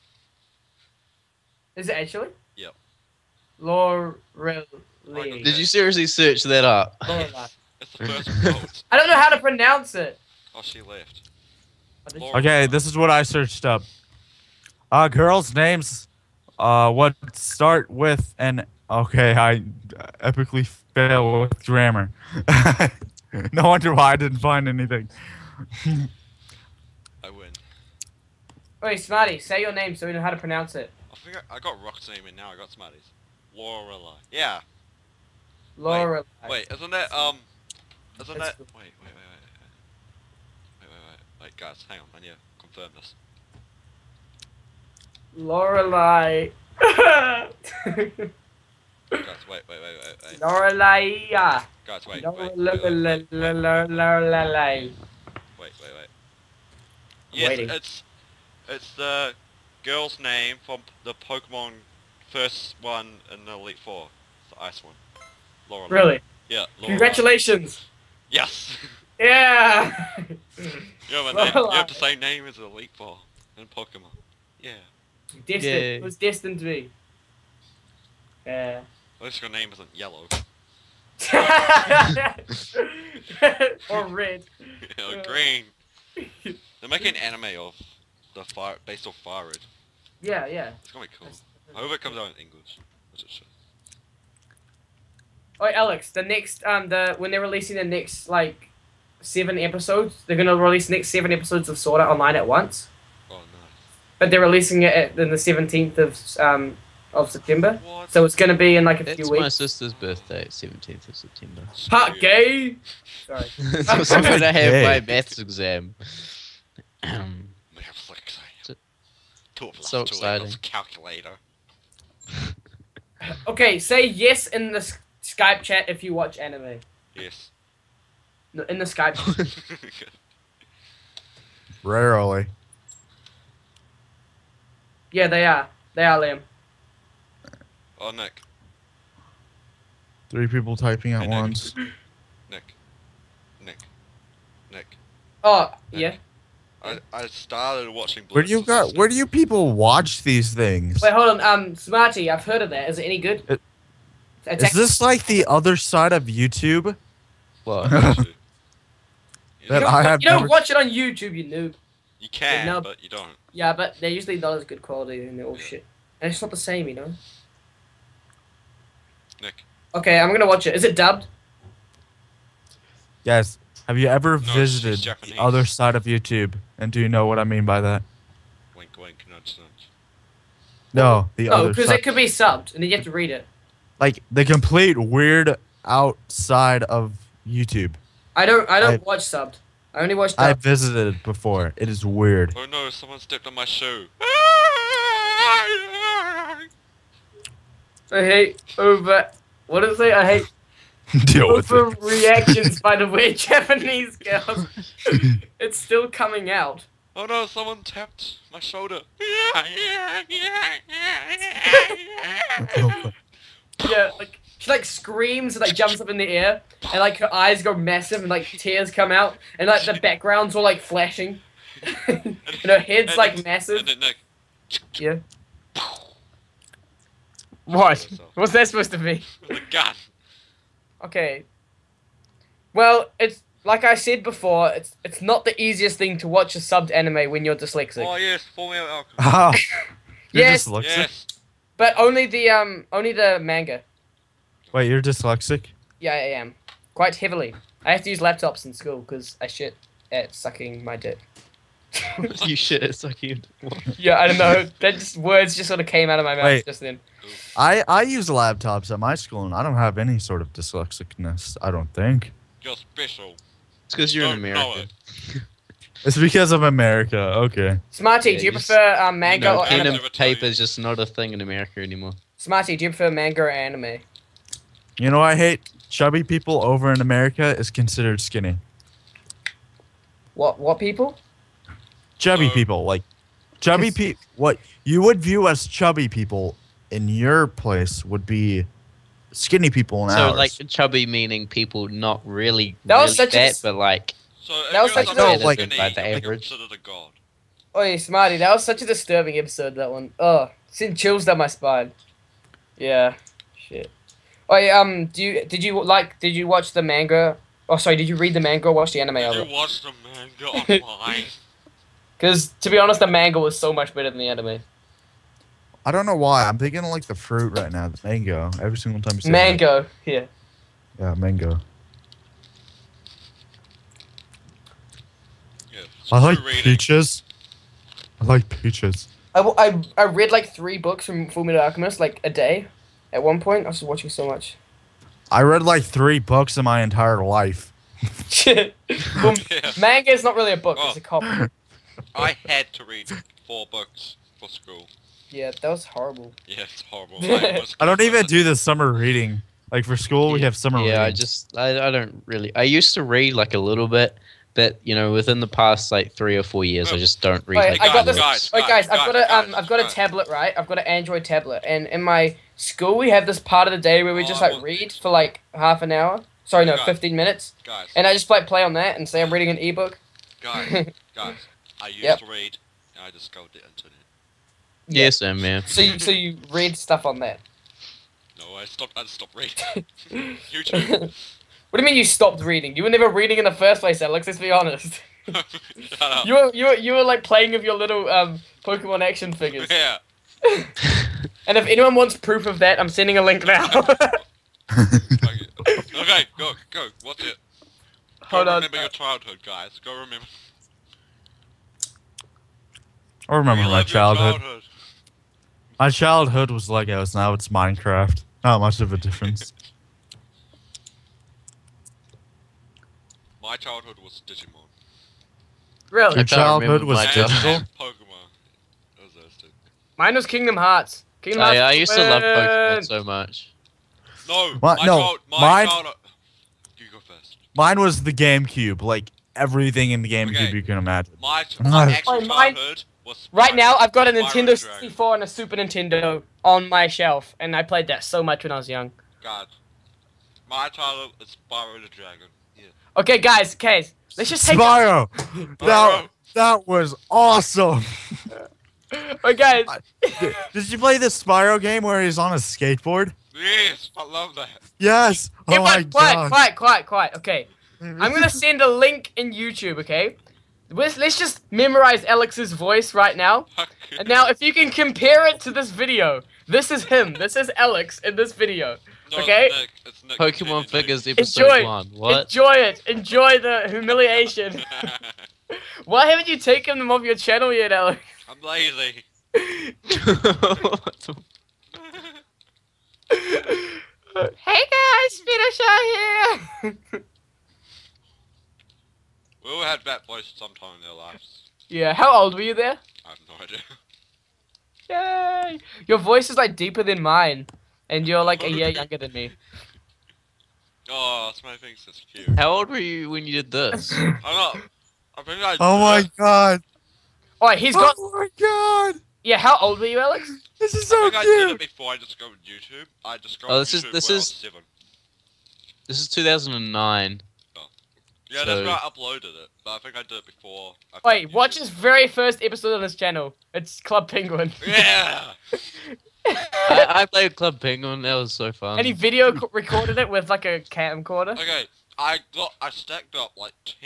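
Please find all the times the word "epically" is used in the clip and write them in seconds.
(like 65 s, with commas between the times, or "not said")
20 s.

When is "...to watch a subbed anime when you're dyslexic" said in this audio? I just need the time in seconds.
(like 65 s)
236 s.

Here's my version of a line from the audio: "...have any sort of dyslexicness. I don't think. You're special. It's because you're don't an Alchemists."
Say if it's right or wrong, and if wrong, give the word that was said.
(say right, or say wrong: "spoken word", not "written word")
wrong: "American", not "Alchemists".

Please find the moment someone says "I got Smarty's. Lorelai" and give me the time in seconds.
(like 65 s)
32 s.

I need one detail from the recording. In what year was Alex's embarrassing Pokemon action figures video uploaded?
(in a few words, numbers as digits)
2009.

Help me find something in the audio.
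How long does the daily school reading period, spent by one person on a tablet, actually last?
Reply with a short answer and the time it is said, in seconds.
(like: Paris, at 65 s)
15 minutes, at 366 s.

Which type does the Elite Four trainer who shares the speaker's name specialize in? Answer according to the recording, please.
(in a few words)
Ice.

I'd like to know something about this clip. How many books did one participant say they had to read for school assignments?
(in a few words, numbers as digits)
4.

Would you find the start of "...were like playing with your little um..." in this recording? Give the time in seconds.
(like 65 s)
386 s.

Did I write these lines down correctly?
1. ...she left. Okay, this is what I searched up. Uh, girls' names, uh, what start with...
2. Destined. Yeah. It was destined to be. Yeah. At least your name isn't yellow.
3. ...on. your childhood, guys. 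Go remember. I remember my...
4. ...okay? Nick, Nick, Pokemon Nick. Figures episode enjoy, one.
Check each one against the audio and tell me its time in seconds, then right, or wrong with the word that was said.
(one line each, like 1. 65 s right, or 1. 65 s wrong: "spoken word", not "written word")
1. 10 s right
2. 75 s right
3. 398 s right
4. 469 s right.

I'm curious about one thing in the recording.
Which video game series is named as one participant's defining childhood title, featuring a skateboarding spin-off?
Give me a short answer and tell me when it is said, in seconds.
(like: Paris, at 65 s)
Spyro the Dragon, at 441 s.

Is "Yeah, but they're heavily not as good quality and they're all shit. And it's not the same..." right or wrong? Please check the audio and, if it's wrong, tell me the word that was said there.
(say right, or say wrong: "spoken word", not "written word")
wrong: "usually", not "heavily".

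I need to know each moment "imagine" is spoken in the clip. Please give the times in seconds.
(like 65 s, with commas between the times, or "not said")
430 s.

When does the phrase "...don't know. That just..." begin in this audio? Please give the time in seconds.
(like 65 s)
254 s.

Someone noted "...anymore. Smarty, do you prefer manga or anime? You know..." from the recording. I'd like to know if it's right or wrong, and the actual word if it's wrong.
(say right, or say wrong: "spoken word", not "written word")
right.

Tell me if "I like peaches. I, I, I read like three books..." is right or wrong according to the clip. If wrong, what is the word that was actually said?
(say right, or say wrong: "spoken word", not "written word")
right.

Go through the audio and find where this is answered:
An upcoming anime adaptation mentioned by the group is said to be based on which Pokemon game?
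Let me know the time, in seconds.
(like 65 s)
89 s.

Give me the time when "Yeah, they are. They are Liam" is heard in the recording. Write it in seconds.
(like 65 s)
135 s.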